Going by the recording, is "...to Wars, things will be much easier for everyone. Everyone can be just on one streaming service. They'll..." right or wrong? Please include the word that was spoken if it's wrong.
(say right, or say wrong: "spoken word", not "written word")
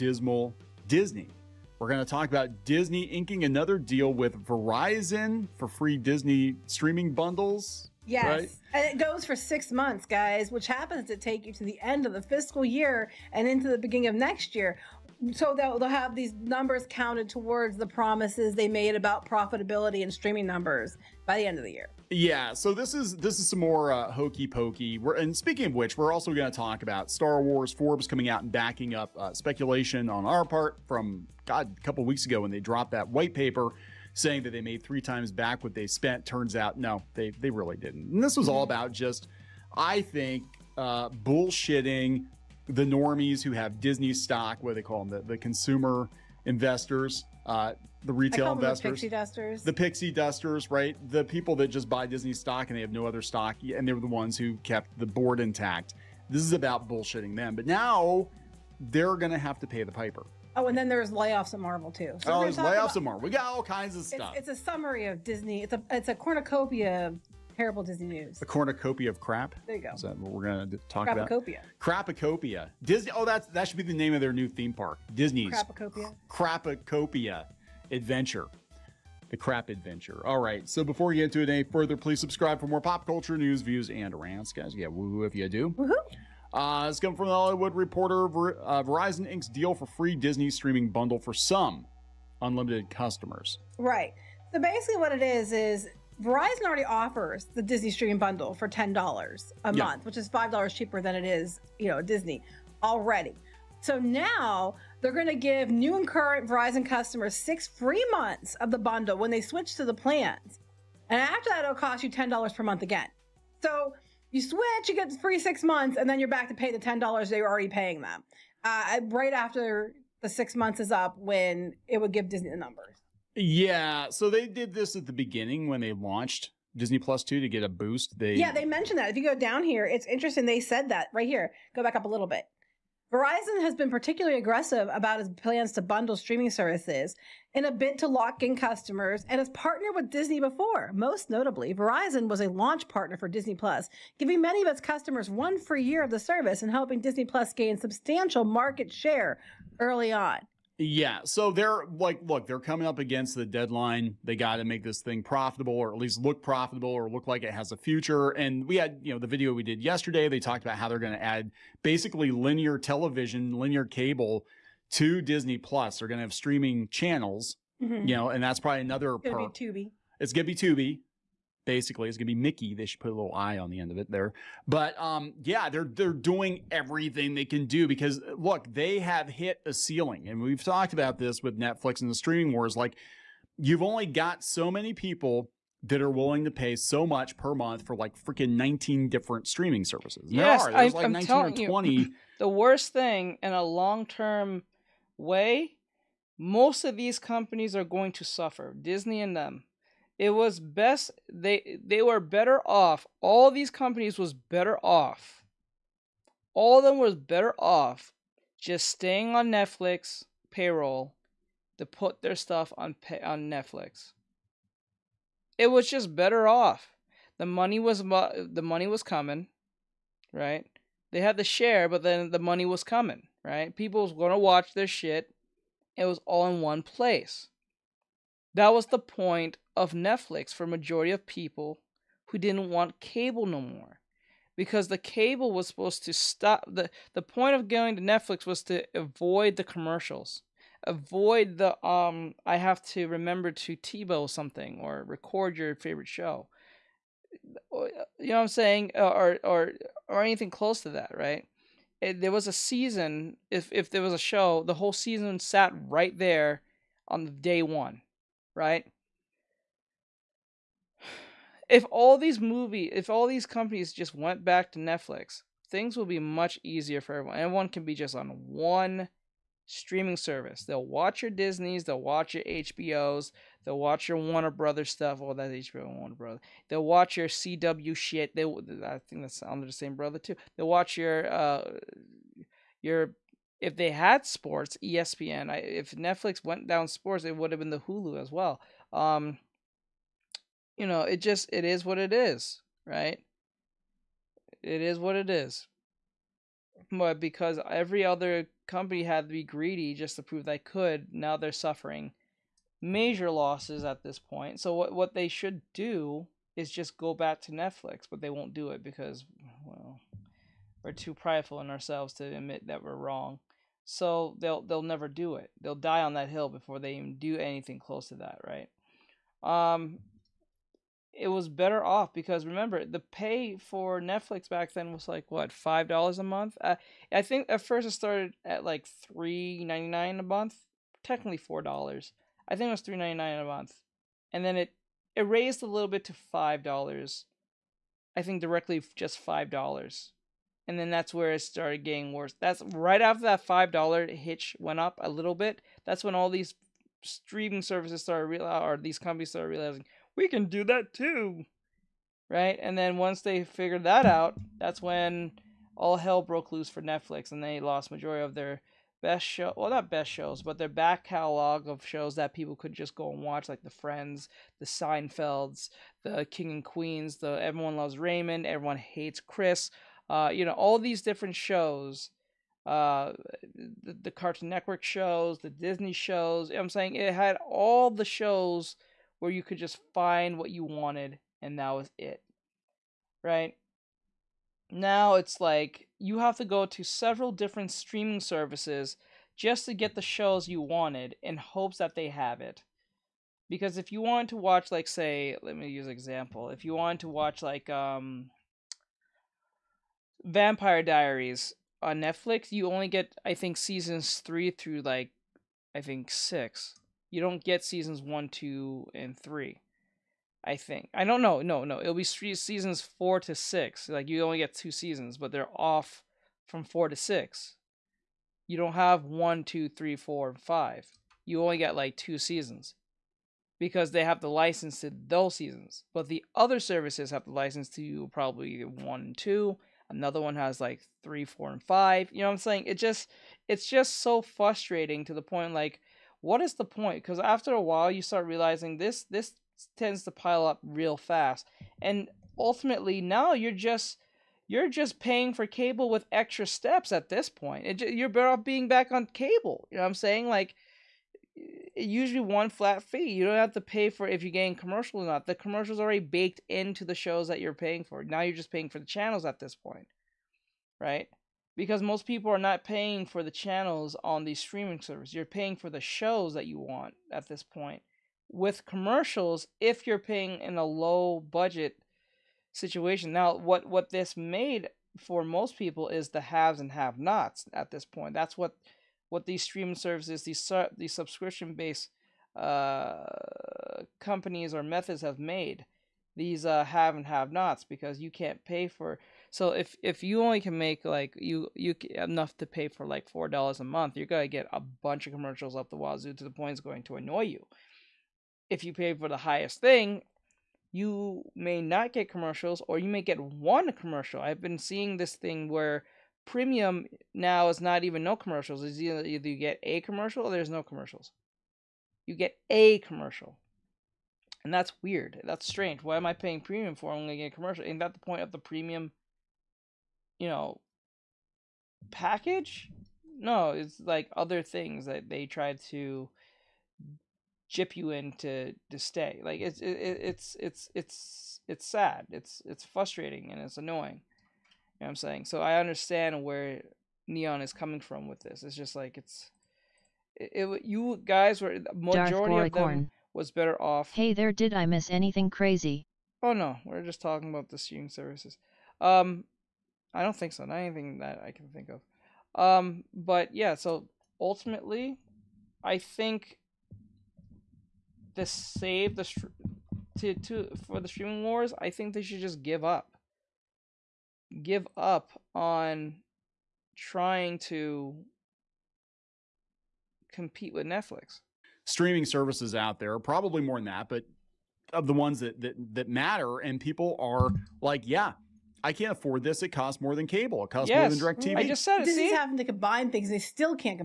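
wrong: "Netflix", not "Wars".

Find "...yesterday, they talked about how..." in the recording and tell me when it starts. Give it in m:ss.
2:39.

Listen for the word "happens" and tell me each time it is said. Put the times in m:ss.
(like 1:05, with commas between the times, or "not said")
0:10.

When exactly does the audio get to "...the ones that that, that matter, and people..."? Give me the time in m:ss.
9:34.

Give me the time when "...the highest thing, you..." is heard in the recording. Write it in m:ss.
8:19.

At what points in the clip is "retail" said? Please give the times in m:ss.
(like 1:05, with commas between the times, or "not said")
0:48.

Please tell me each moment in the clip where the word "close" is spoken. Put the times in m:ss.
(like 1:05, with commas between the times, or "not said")
4:10, 5:17.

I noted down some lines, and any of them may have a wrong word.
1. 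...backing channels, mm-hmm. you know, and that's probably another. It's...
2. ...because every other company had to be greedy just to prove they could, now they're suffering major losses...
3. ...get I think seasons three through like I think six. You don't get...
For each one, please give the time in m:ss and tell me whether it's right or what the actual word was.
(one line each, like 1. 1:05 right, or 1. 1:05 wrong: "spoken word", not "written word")
1. 2:46 wrong: "streaming", not "backing"
2. 4:57 right
3. 6:42 right.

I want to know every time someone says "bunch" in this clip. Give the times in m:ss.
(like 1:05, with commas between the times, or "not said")
8:14.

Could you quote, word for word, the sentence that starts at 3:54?
Because the cable was supposed to stop the the point of going to Netflix was to avoid the commercials.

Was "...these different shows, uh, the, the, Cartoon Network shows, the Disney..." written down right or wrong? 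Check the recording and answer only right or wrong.
right.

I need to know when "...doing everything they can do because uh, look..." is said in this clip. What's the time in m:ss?
2:56.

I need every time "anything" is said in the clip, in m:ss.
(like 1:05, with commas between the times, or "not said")
4:10, 5:17, 9:04, 9:10.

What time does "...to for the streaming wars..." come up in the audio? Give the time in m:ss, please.
9:20.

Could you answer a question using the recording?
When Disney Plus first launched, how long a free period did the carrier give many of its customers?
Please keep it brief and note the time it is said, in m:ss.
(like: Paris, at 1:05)
1 year, at 2:25.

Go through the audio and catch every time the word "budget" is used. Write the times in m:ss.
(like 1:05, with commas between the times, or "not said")
7:51.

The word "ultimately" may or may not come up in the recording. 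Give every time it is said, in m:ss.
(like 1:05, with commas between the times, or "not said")
7:22, 9:14.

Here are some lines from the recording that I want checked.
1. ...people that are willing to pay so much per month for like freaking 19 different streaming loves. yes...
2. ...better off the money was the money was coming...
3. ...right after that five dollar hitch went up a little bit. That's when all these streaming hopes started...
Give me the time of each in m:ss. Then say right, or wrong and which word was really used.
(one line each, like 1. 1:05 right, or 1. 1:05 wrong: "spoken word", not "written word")
1. 3:04 wrong: "services", not "loves"
2. 3:36 right
3. 5:42 wrong: "services", not "hopes".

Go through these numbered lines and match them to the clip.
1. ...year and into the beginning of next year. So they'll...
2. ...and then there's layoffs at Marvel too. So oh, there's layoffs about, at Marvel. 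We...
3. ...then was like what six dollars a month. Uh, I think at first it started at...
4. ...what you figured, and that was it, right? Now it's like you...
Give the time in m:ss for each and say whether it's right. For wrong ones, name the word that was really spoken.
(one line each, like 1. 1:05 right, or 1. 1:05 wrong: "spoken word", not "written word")
1. 0:12 right
2. 1:00 right
3. 5:24 wrong: "five", not "six"
4. 6:20 wrong: "wanted", not "figured".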